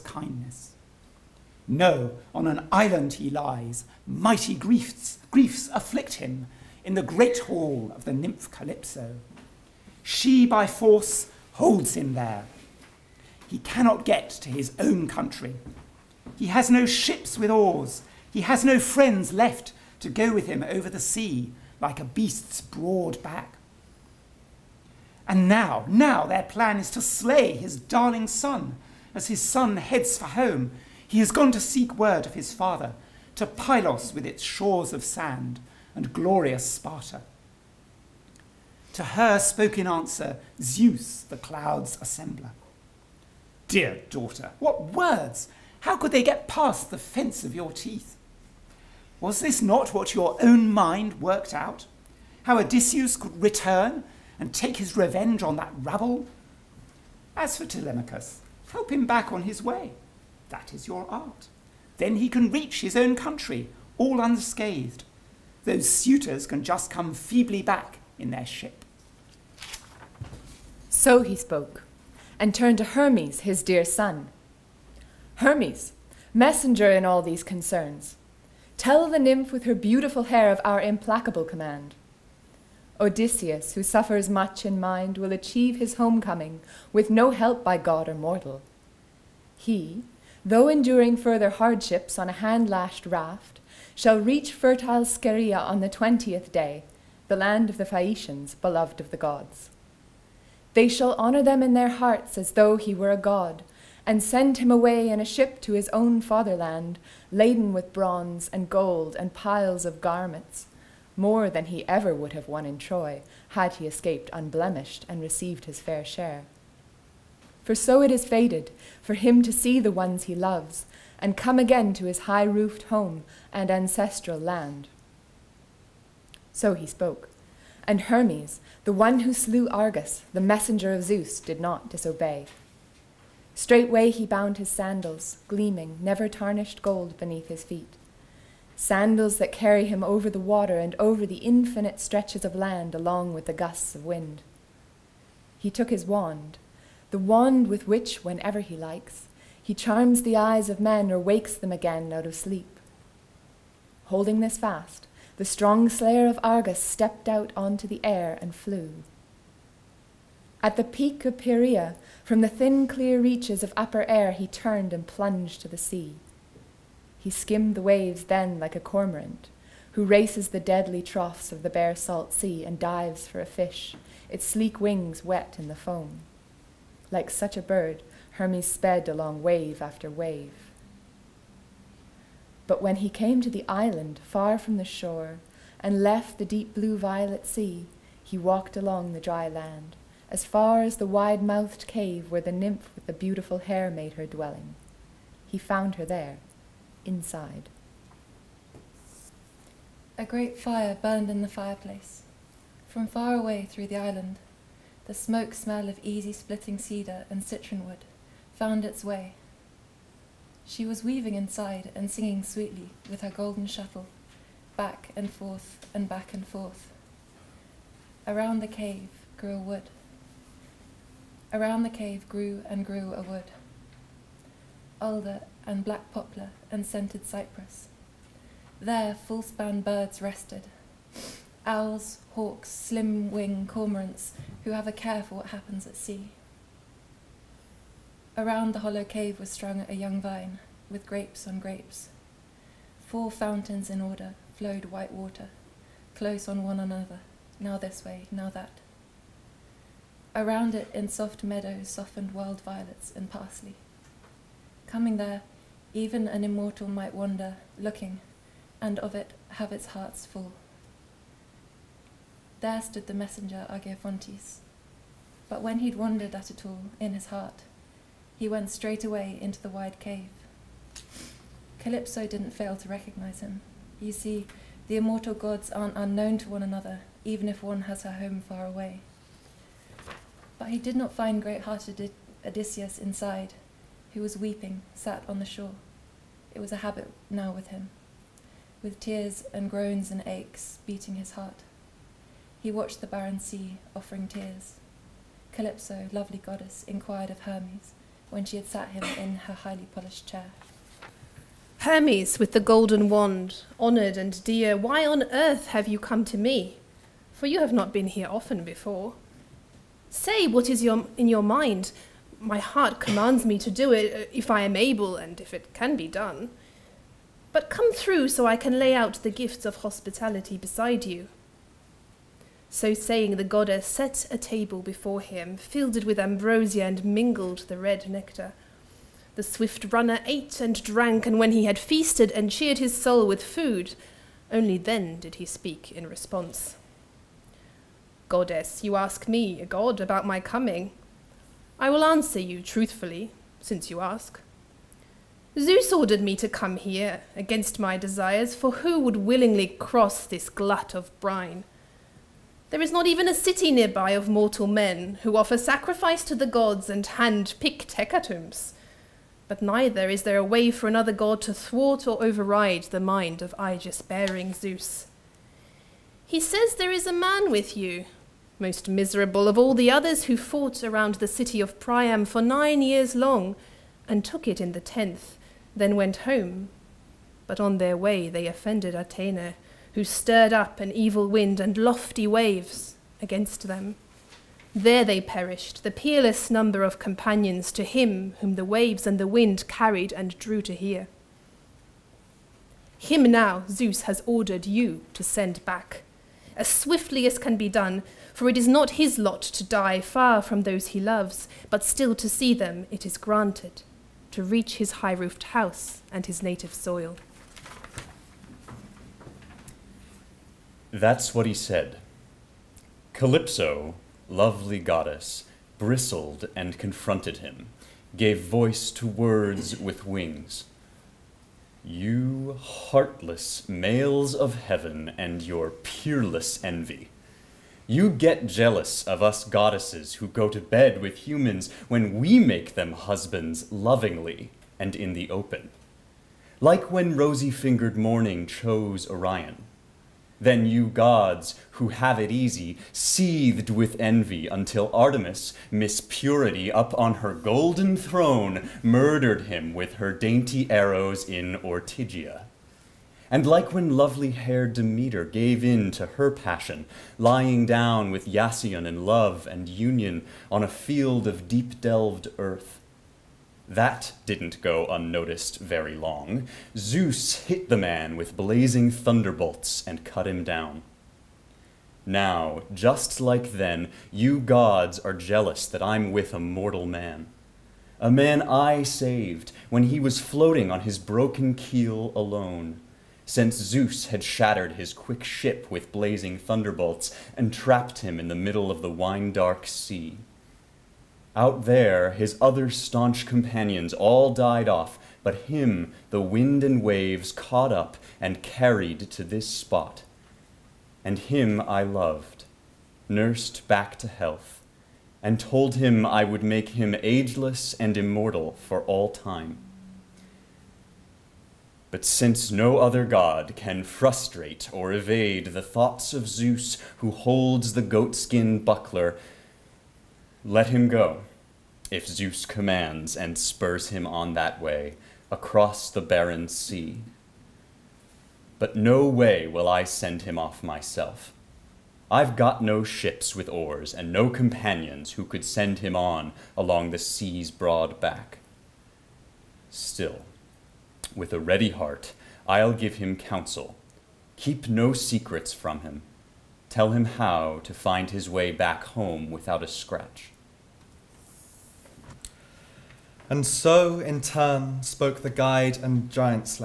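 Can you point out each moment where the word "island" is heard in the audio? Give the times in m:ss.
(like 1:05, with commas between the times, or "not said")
0:02, 3:03, 3:23.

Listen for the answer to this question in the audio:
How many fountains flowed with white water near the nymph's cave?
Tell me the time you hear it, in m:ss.
4:03.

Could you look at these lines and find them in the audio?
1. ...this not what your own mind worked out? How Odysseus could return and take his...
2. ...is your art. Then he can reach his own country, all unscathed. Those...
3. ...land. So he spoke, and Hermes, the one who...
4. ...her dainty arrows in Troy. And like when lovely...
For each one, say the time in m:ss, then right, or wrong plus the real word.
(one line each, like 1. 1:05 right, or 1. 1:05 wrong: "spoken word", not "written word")
1. 0:49 right
2. 1:00 right
3. 2:04 right
4. 7:29 wrong: "Ortygia", not "Troy".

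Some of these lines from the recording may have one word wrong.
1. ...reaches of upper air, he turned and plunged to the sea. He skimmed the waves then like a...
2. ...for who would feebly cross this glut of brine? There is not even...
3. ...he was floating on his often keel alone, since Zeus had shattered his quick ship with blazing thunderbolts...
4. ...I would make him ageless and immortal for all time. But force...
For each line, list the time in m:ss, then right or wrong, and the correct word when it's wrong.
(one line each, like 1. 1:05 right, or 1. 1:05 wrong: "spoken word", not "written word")
1. 2:43 right
2. 5:48 wrong: "willingly", not "feebly"
3. 7:59 wrong: "broken", not "often"
4. 8:26 wrong: "since", not "force".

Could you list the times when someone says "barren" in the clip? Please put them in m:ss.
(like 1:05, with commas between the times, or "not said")
4:53, 8:45.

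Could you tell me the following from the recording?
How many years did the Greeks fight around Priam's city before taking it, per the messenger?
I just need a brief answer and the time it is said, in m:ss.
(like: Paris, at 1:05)
9, at 6:12.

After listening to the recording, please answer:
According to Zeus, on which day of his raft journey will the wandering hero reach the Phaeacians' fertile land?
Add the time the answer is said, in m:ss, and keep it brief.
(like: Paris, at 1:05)
20th, at 1:35.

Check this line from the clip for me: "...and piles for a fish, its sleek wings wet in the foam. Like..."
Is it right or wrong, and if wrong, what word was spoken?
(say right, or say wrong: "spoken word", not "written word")
wrong: "dives", not "piles".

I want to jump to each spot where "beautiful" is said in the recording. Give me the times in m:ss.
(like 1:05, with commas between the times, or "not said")
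1:19, 3:13.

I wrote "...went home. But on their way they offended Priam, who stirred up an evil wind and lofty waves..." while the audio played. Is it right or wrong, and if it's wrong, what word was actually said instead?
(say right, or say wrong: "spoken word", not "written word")
wrong: "Athena", not "Priam".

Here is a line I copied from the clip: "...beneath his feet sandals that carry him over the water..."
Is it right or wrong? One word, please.
right.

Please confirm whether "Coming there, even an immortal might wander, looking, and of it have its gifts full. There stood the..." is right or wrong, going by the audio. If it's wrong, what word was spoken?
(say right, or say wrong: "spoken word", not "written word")
wrong: "hearts", not "gifts".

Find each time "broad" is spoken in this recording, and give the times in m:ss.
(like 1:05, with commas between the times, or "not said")
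0:22, 8:57.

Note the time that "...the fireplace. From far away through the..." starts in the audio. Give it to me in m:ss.
3:21.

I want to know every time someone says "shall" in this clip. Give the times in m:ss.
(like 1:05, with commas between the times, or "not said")
1:33, 1:40.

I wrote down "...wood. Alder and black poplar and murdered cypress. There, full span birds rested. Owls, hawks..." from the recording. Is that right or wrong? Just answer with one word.
wrong.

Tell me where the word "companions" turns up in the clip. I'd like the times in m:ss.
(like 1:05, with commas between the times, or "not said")
6:26, 8:13, 8:54.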